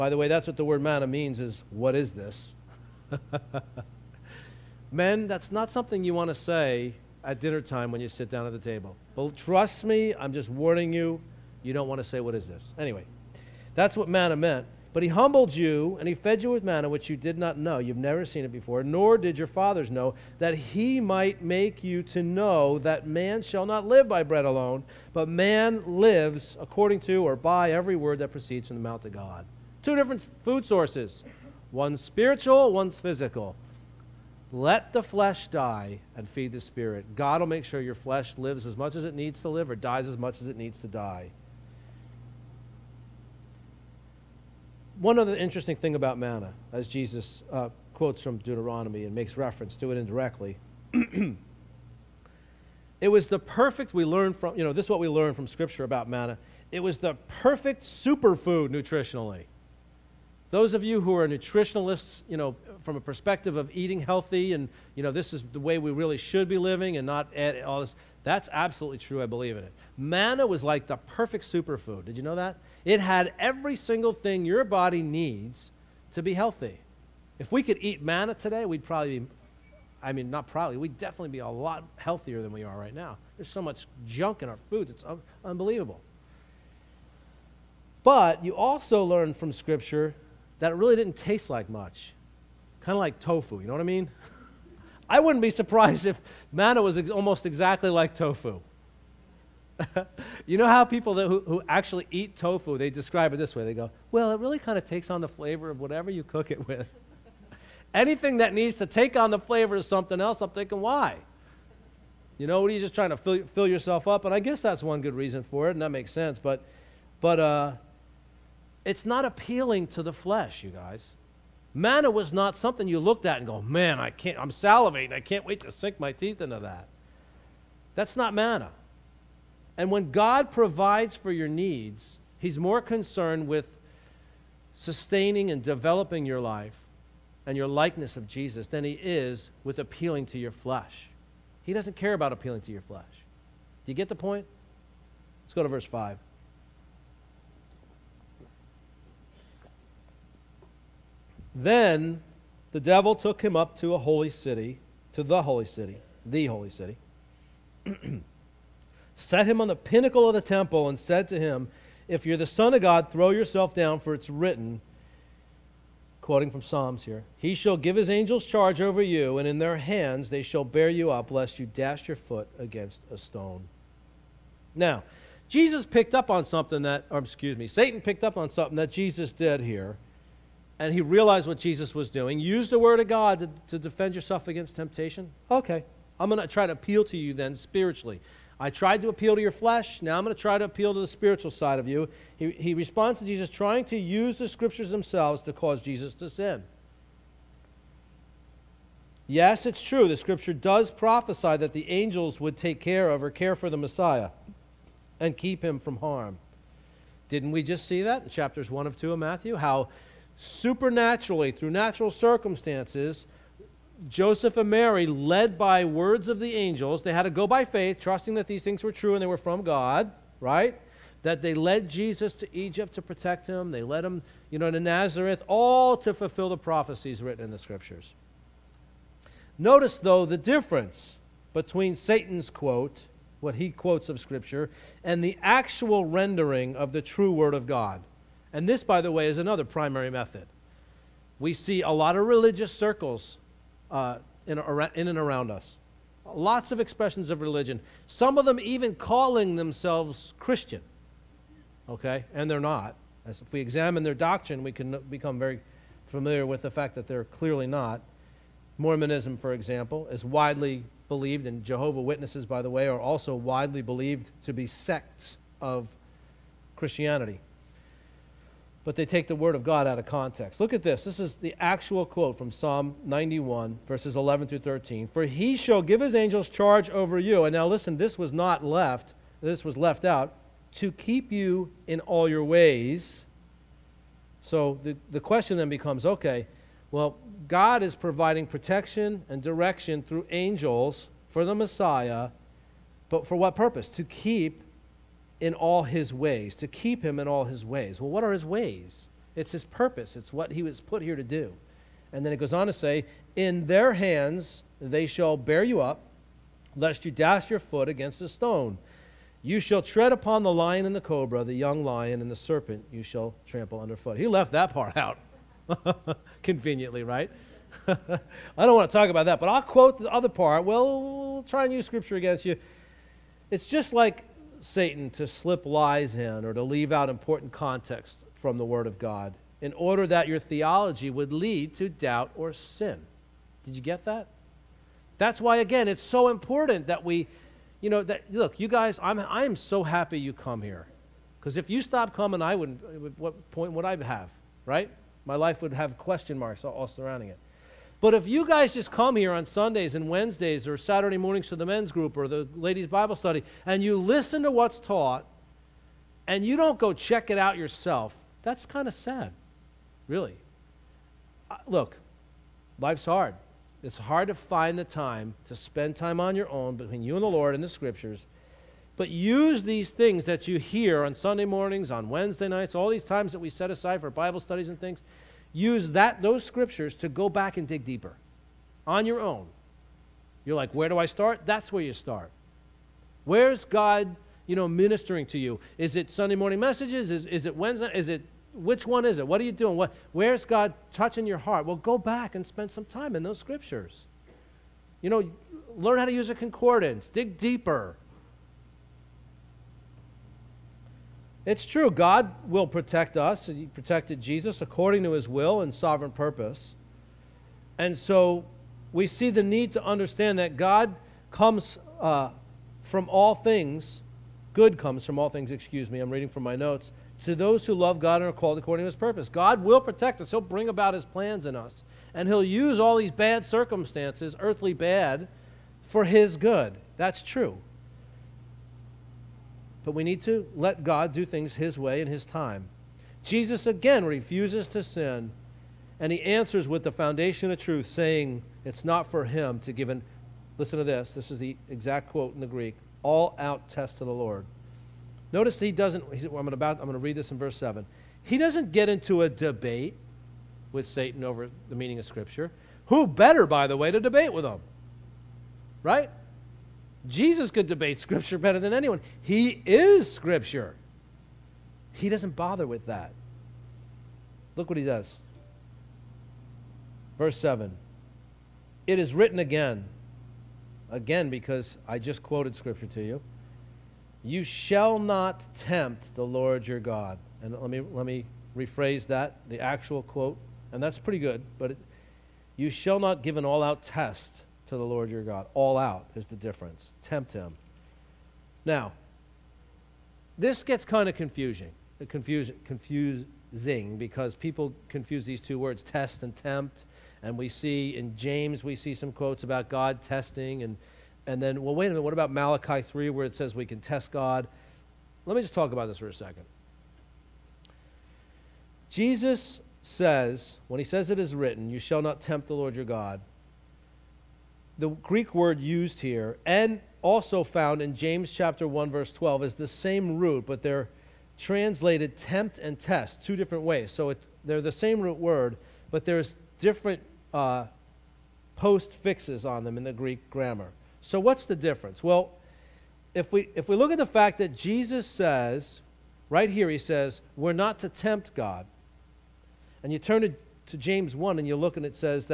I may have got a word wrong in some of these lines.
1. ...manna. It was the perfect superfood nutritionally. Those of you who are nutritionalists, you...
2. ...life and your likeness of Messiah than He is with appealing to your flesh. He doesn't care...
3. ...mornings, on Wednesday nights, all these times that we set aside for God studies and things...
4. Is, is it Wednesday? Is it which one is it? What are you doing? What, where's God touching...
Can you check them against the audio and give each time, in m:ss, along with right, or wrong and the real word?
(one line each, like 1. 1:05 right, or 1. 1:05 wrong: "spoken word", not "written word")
1. 0:56 right
2. 2:16 wrong: "Jesus", not "Messiah"
3. 6:11 wrong: "Bible", not "God"
4. 6:27 right.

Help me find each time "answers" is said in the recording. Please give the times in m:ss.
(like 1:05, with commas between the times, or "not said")
7:16.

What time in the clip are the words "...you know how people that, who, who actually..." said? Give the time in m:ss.
1:40.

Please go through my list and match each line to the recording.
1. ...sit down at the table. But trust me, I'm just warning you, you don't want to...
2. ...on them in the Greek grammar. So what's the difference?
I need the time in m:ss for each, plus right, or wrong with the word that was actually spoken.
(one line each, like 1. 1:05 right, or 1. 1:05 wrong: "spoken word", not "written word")
1. 0:08 right
2. 8:49 right.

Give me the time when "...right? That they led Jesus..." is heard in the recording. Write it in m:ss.
3:40.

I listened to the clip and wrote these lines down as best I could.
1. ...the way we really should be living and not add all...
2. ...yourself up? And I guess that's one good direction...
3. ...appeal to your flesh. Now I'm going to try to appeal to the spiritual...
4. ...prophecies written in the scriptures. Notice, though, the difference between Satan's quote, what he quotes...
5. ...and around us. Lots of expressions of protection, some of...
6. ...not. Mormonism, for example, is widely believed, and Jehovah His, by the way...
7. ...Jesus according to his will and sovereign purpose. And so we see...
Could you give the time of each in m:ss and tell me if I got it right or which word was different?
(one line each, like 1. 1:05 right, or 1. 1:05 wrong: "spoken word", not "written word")
1. 1:05 right
2. 1:53 wrong: "reason", not "direction"
3. 3:09 right
4. 3:46 right
5. 4:05 wrong: "religion", not "protection"
6. 4:17 wrong: "Witnesses", not "His"
7. 6:44 right.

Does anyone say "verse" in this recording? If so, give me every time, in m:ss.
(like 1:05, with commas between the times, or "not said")
2:25, 4:33, 7:27, 7:47, 8:38.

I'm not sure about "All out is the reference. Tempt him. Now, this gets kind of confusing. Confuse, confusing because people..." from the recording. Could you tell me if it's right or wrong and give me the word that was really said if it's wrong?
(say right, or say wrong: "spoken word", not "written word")
wrong: "difference", not "reference".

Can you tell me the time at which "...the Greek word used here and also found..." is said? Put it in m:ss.
8:34.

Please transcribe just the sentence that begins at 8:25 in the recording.
Let me just talk about this for a second.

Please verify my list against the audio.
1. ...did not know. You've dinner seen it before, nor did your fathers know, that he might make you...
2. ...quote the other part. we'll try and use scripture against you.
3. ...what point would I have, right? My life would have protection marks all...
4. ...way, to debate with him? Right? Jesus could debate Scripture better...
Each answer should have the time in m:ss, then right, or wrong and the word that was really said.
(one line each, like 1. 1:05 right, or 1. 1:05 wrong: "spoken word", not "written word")
1. 0:17 wrong: "never", not "dinner"
2. 5:19 right
3. 5:43 wrong: "question", not "protection"
4. 7:33 right.